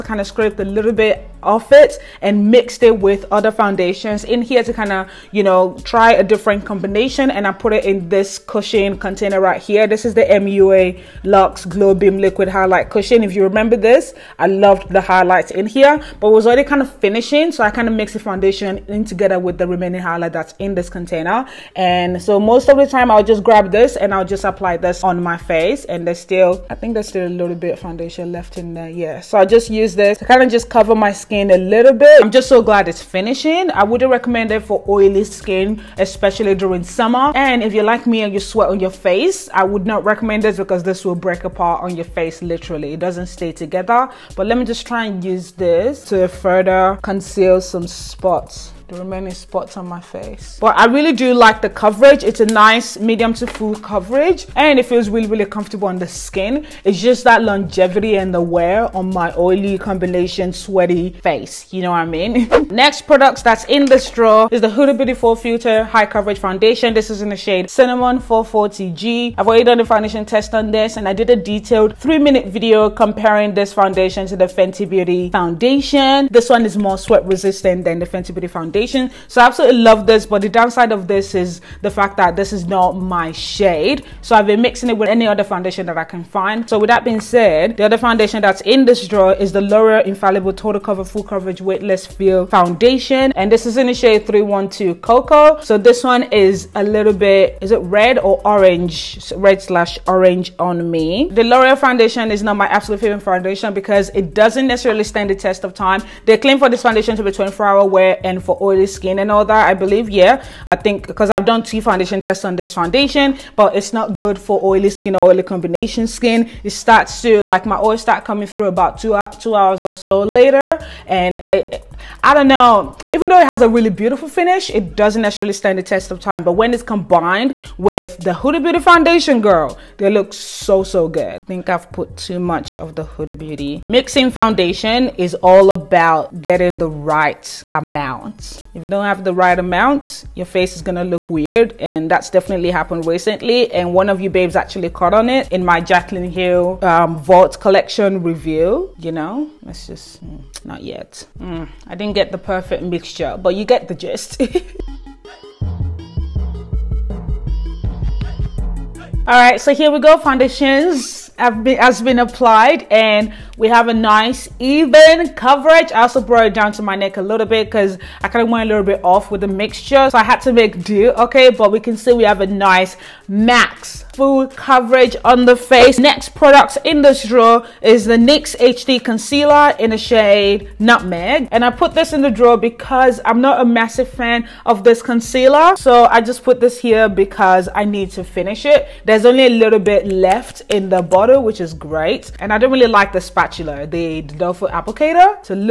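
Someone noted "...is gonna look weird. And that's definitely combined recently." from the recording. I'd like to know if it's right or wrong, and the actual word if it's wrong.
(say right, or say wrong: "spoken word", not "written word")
wrong: "happened", not "combined".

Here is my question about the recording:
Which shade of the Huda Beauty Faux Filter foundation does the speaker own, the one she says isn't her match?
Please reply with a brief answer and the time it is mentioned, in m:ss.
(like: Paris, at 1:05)
Cinnamon 440G, at 1:07.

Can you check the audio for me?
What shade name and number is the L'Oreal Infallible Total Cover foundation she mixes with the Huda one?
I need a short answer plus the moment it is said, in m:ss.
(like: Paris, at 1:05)
312 Cocoa, at 1:34.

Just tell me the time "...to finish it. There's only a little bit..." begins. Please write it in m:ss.
3:08.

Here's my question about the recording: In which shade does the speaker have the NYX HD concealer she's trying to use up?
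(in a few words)
Nutmeg.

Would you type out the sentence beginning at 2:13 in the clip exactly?
Mixing foundation is all about getting the right amount.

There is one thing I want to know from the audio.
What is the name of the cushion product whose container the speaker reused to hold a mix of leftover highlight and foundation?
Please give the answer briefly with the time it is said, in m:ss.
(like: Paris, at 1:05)
MUA Lux Glow Beam Liquid Highlight Cushion, at 0:10.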